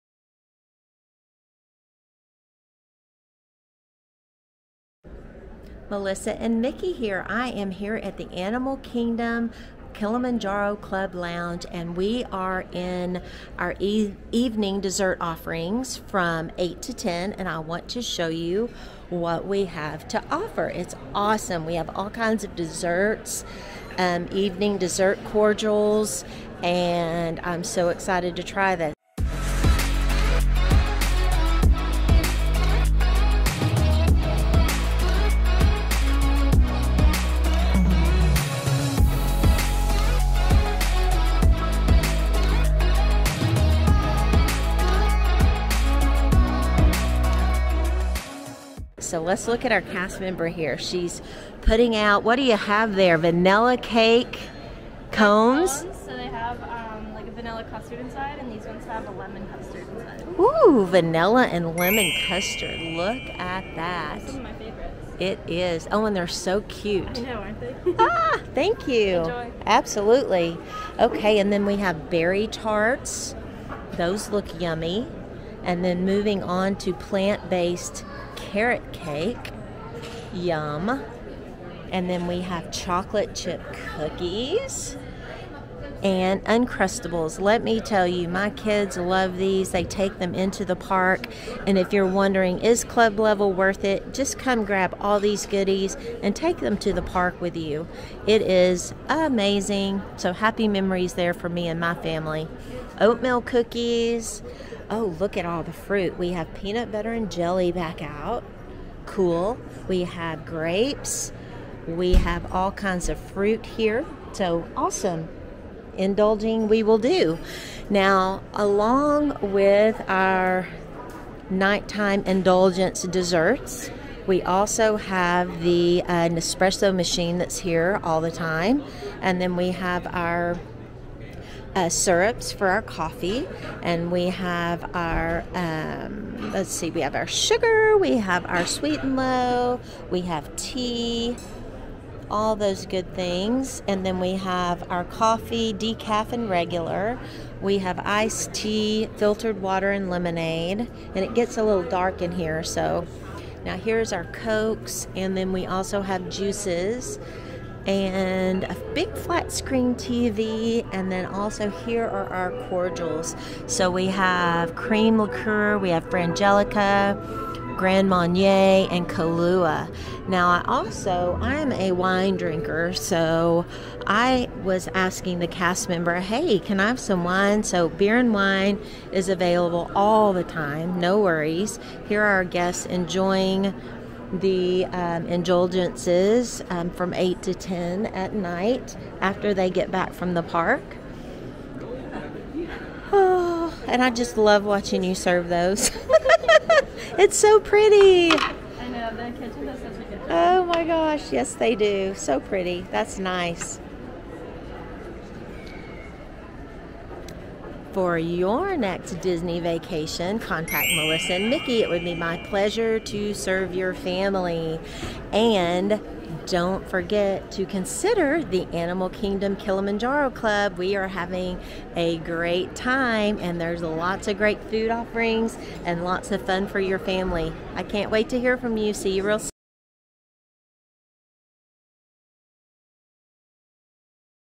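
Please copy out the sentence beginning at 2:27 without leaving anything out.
We have iced tea, filtered water, and lemonade, and it gets a little dark in here, so.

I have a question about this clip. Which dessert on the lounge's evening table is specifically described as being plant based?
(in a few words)
Carrot cake.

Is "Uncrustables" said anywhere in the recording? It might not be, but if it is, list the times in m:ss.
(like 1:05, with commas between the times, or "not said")
1:26.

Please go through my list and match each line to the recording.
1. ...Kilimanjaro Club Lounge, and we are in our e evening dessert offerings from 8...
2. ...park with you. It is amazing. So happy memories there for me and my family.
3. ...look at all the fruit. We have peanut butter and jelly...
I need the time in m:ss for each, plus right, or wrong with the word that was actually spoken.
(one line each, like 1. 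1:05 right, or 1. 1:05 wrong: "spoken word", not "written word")
1. 0:09 right
2. 1:37 right
3. 1:45 right.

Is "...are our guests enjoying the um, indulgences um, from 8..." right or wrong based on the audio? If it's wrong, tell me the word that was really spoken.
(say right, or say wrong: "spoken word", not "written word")
right.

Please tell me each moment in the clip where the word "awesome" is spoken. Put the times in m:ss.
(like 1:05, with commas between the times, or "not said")
0:21, 1:54.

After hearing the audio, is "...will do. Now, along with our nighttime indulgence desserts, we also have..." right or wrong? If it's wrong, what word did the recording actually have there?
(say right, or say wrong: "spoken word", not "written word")
right.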